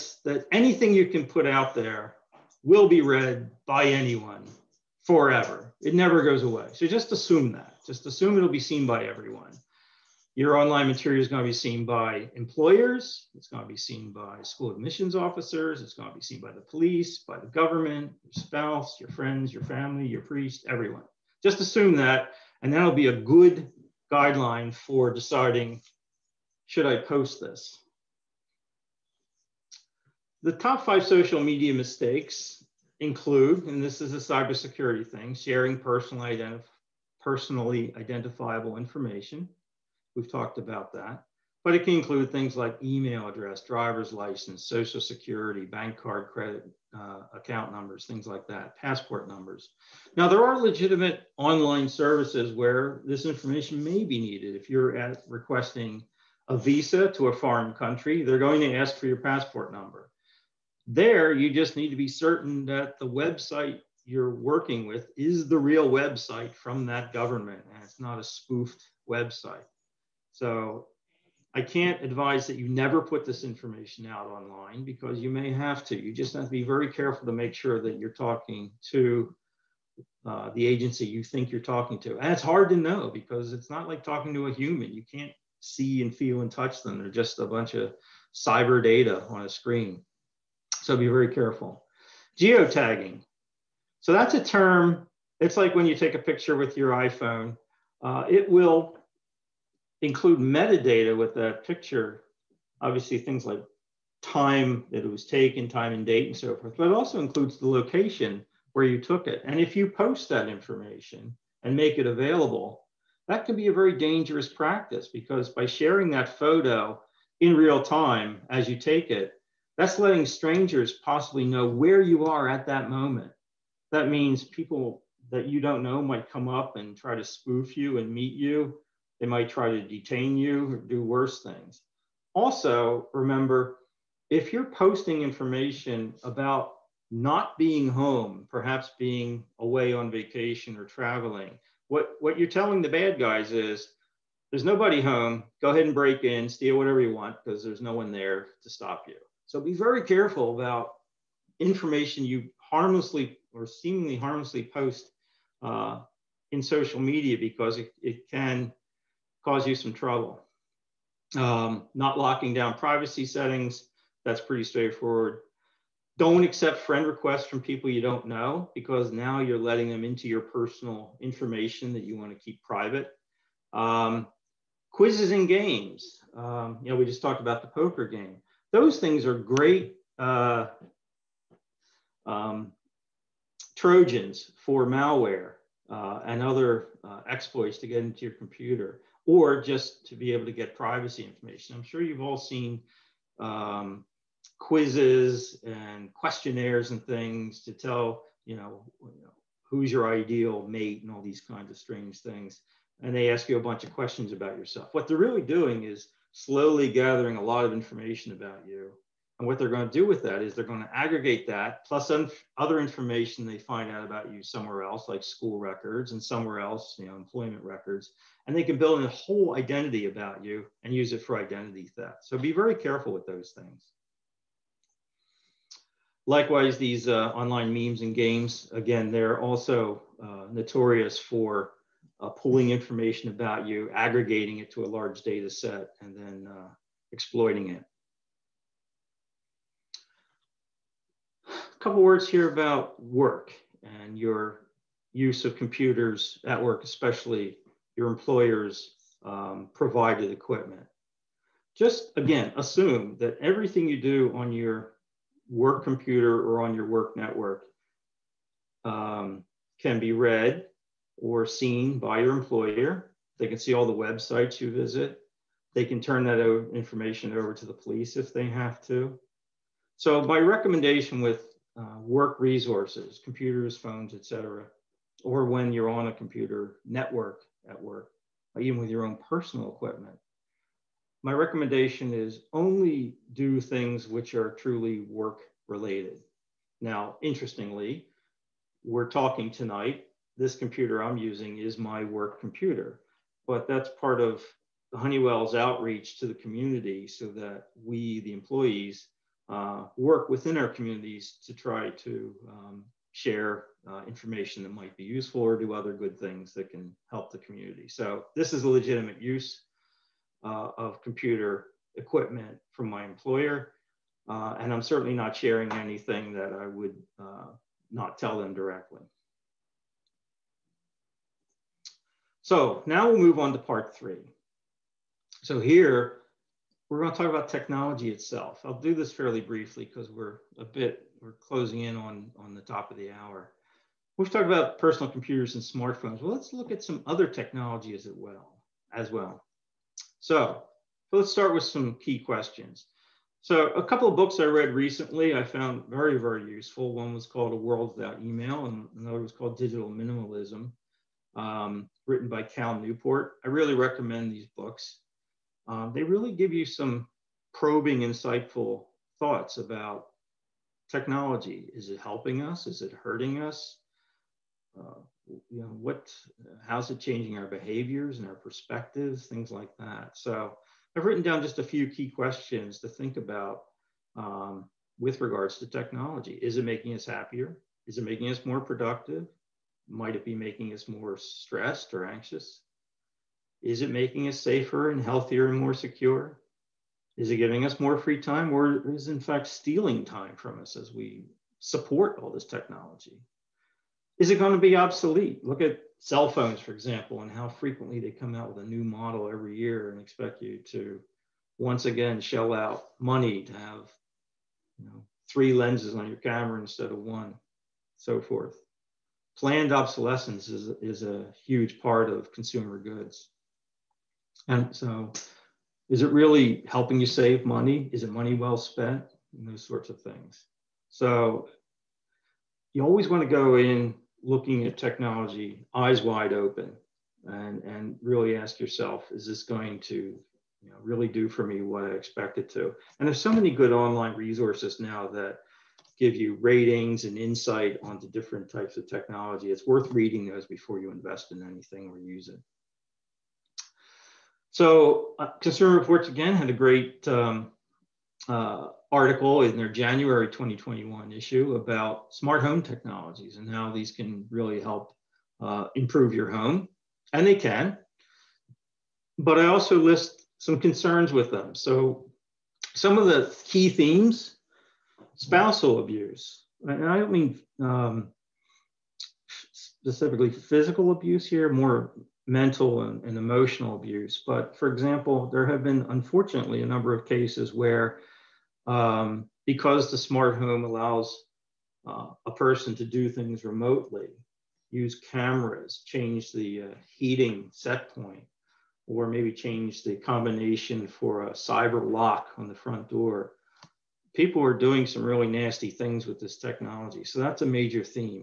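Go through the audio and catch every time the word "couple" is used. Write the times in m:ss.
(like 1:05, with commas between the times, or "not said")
4:01, 5:43.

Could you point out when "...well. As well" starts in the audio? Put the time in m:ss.
5:38.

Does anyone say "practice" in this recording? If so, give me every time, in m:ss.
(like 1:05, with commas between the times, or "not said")
1:54.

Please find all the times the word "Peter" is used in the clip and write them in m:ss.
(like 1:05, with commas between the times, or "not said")
not said.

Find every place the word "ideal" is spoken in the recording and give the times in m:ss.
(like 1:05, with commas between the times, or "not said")
3:20.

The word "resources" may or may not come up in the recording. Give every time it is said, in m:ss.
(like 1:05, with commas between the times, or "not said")
4:32, 7:14.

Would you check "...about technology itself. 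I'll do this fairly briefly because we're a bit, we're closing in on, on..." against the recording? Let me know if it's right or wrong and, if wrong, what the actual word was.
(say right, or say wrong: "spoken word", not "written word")
right.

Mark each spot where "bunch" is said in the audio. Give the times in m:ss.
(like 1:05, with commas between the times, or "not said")
1:27, 3:23.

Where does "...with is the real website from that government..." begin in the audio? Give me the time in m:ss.
1:04.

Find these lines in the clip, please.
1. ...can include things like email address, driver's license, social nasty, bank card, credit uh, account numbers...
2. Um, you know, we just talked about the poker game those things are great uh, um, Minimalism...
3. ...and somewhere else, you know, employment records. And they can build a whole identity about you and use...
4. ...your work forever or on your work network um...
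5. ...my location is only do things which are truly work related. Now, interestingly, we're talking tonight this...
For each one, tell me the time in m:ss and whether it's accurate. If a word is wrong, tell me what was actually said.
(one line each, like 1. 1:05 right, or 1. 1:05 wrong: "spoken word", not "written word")
1. 0:41 wrong: "security", not "nasty"
2. 2:56 wrong: "Trojans", not "Minimalism"
3. 3:36 right
4. 4:14 wrong: "computer", not "forever"
5. 4:41 wrong: "recommendation", not "location".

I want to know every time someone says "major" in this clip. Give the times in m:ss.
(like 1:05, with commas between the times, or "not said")
8:17.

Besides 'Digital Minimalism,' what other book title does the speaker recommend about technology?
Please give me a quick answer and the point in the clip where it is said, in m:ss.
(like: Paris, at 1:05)
A World Without Email, at 5:47.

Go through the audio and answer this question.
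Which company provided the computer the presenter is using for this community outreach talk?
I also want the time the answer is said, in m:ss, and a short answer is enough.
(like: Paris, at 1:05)
Honeywell, at 4:54.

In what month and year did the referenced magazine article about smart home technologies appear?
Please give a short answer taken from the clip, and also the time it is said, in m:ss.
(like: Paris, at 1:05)
January 2021, at 7:29.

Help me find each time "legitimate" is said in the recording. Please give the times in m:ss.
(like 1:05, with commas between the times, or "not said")
0:50, 5:08.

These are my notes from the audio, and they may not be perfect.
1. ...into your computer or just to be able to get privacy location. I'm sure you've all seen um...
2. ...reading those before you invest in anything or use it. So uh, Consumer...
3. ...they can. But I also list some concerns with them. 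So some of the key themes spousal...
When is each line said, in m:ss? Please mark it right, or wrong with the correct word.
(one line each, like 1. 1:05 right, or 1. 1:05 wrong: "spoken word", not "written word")
1. 3:07 wrong: "information", not "location"
2. 7:19 right
3. 7:37 right.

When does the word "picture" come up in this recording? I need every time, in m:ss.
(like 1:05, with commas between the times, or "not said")
1:36, 1:41.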